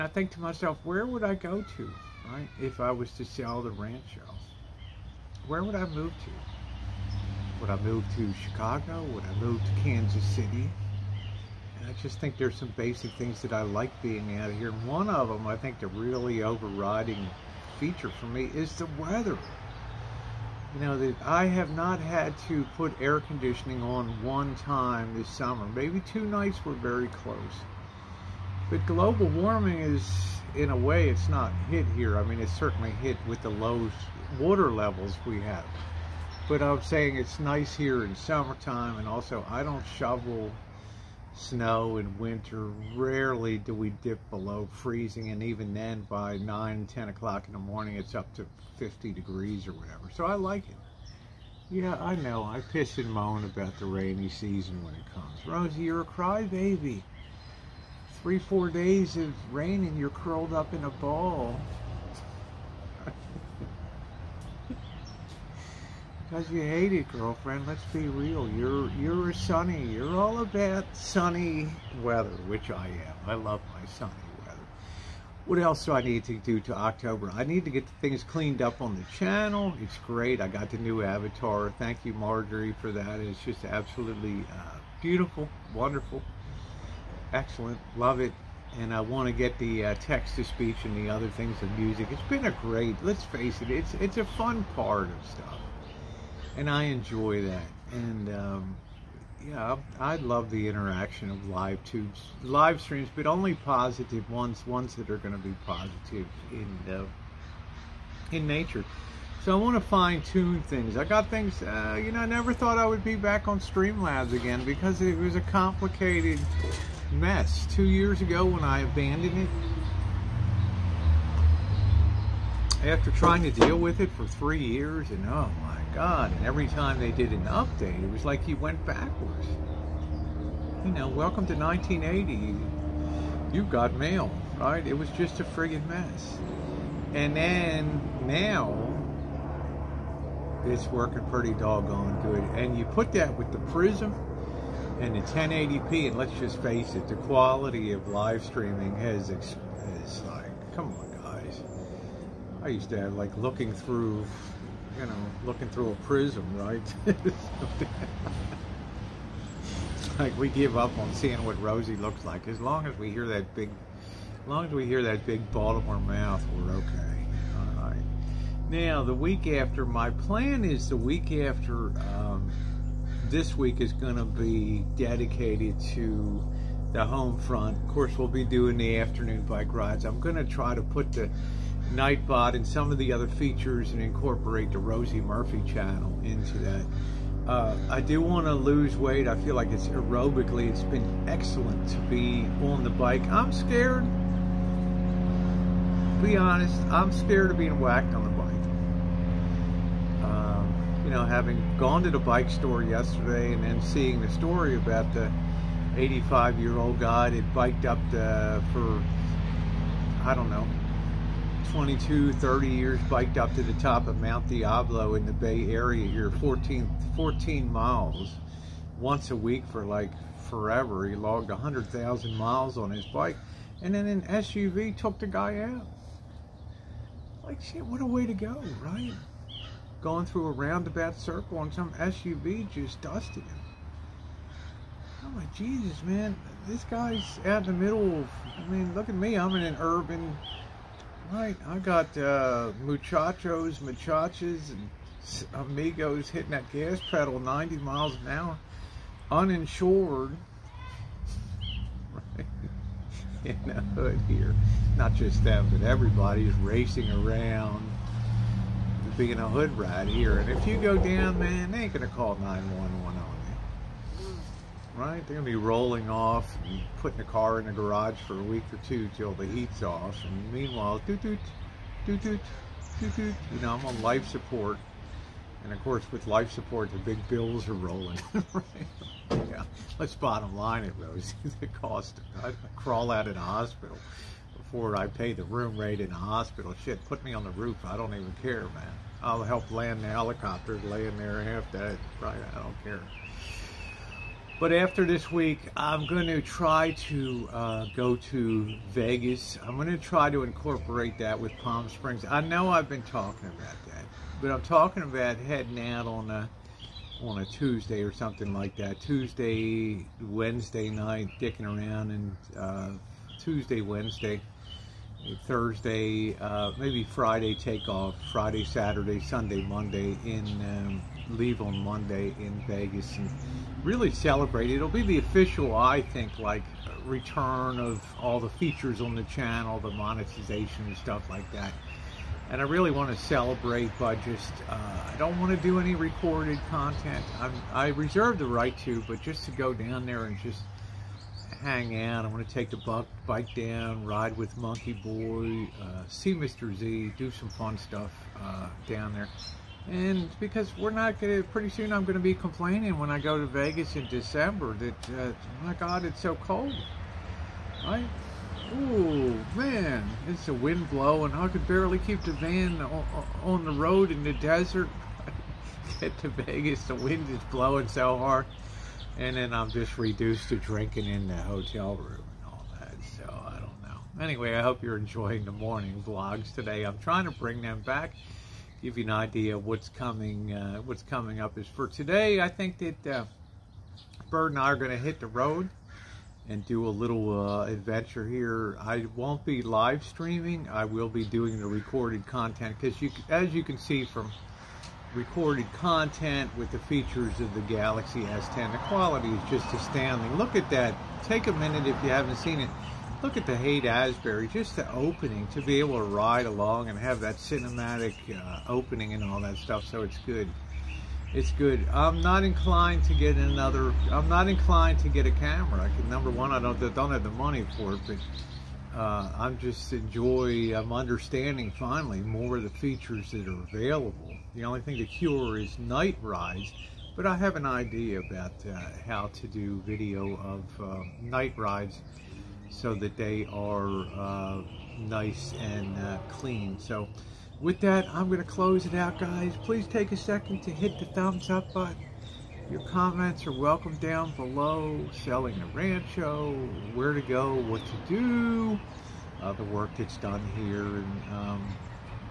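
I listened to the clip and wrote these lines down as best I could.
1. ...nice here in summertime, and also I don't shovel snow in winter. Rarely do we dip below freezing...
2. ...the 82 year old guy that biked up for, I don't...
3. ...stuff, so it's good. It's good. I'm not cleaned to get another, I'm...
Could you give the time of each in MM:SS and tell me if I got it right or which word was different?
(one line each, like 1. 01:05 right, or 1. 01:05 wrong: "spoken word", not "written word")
1. 00:37 right
2. 03:25 wrong: "85", not "82"
3. 06:49 wrong: "inclined", not "cleaned".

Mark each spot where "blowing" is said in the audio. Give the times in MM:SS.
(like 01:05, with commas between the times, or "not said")
06:00, 06:07.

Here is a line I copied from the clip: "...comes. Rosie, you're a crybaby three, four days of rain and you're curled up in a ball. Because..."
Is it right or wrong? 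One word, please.
right.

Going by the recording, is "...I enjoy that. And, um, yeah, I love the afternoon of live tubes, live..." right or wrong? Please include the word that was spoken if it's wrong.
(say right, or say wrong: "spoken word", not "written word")
wrong: "interaction", not "afternoon".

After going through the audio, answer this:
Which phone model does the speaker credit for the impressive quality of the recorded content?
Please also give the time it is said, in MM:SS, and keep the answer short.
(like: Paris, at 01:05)
Galaxy S10, at 06:37.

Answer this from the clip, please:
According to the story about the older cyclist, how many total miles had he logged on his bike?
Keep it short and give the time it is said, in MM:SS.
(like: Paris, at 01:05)
100,000, at 03:41.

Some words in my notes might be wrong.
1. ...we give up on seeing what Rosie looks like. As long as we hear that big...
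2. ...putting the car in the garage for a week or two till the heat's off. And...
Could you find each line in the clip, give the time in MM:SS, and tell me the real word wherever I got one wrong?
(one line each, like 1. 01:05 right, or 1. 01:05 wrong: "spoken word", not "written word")
1. 02:40 right
2. 04:27 right.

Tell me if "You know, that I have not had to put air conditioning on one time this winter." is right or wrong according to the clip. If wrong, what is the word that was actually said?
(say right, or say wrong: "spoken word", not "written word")
wrong: "summer", not "winter".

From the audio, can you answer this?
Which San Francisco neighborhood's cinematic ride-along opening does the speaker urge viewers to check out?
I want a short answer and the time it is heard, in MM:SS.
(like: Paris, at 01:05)
Haight Ashbury, at 06:43.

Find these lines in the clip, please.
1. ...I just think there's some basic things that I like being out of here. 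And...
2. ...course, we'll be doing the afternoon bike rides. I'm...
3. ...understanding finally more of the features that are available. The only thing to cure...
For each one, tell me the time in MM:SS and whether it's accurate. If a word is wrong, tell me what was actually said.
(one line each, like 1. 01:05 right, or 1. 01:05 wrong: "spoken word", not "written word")
1. 00:11 right
2. 02:57 right
3. 07:00 right.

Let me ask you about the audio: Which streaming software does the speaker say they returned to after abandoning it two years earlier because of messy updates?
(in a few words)
Streamlabs.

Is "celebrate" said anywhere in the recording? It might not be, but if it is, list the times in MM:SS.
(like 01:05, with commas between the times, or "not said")
05:24, 05:33.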